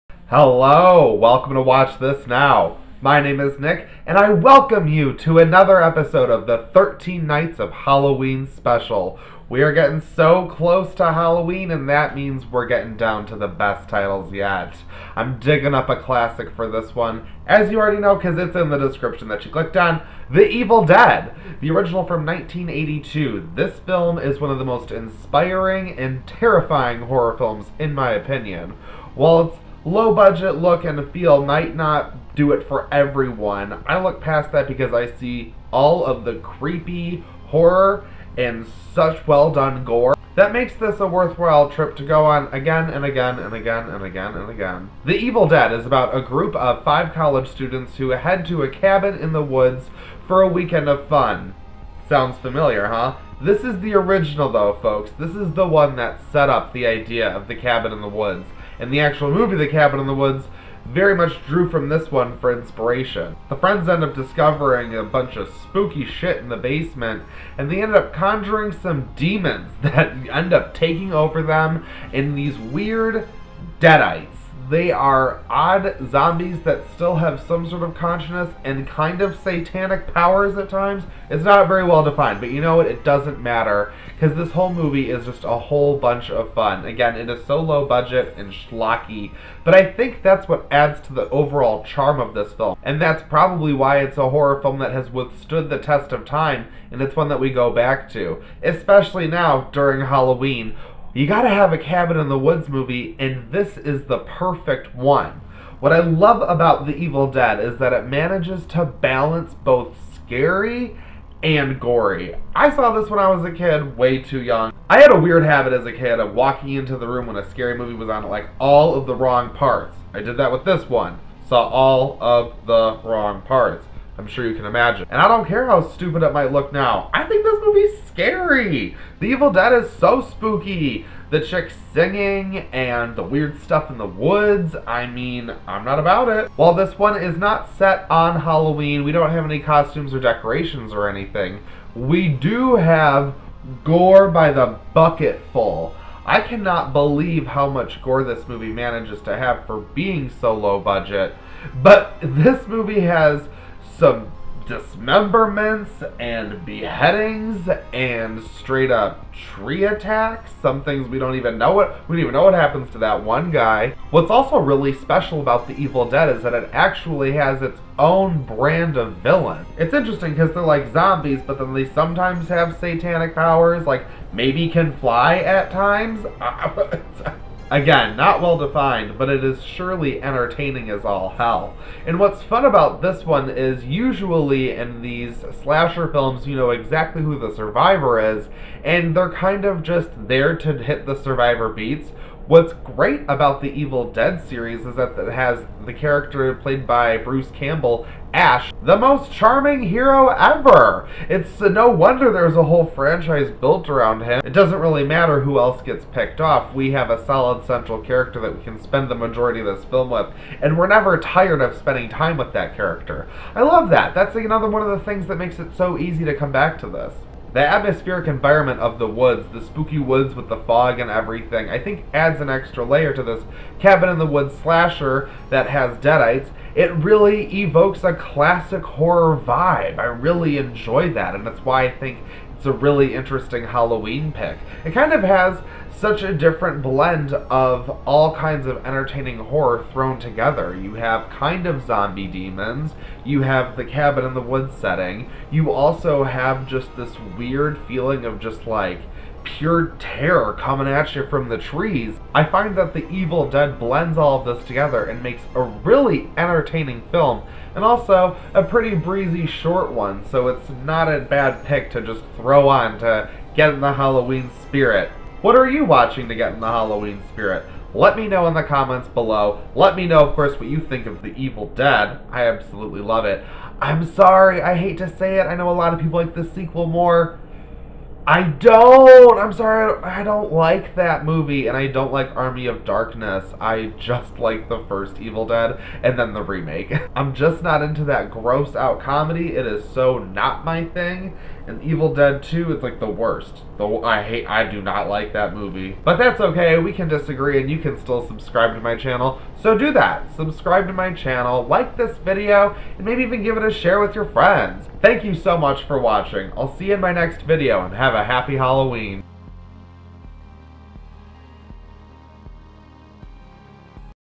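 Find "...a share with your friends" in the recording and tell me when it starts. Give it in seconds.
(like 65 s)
303 s.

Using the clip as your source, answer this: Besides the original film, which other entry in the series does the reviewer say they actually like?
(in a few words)
the remake.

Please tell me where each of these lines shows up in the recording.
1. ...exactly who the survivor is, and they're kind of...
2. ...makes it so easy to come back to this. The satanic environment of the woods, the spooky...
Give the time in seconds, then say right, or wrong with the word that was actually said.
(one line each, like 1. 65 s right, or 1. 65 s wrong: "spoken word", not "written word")
1. 186 s right
2. 215 s wrong: "atmospheric", not "satanic".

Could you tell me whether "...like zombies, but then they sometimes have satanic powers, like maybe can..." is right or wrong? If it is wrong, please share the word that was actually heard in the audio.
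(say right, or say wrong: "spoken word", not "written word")
right.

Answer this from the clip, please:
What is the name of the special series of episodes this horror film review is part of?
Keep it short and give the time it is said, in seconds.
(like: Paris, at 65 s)
13 Nights of Halloween, at 6 s.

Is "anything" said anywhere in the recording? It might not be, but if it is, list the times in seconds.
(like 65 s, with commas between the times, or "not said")
141 s.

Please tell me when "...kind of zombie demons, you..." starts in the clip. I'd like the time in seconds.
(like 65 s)
241 s.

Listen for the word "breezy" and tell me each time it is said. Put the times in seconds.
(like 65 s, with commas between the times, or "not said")
258 s.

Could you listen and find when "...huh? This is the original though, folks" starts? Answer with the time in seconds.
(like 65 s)
52 s.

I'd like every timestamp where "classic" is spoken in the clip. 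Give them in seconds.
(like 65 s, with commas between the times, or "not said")
16 s, 228 s.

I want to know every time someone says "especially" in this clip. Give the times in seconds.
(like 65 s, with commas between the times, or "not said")
98 s.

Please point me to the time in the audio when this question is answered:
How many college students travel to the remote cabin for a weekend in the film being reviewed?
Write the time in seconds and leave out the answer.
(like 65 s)
46 s.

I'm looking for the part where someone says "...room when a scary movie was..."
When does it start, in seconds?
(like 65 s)
117 s.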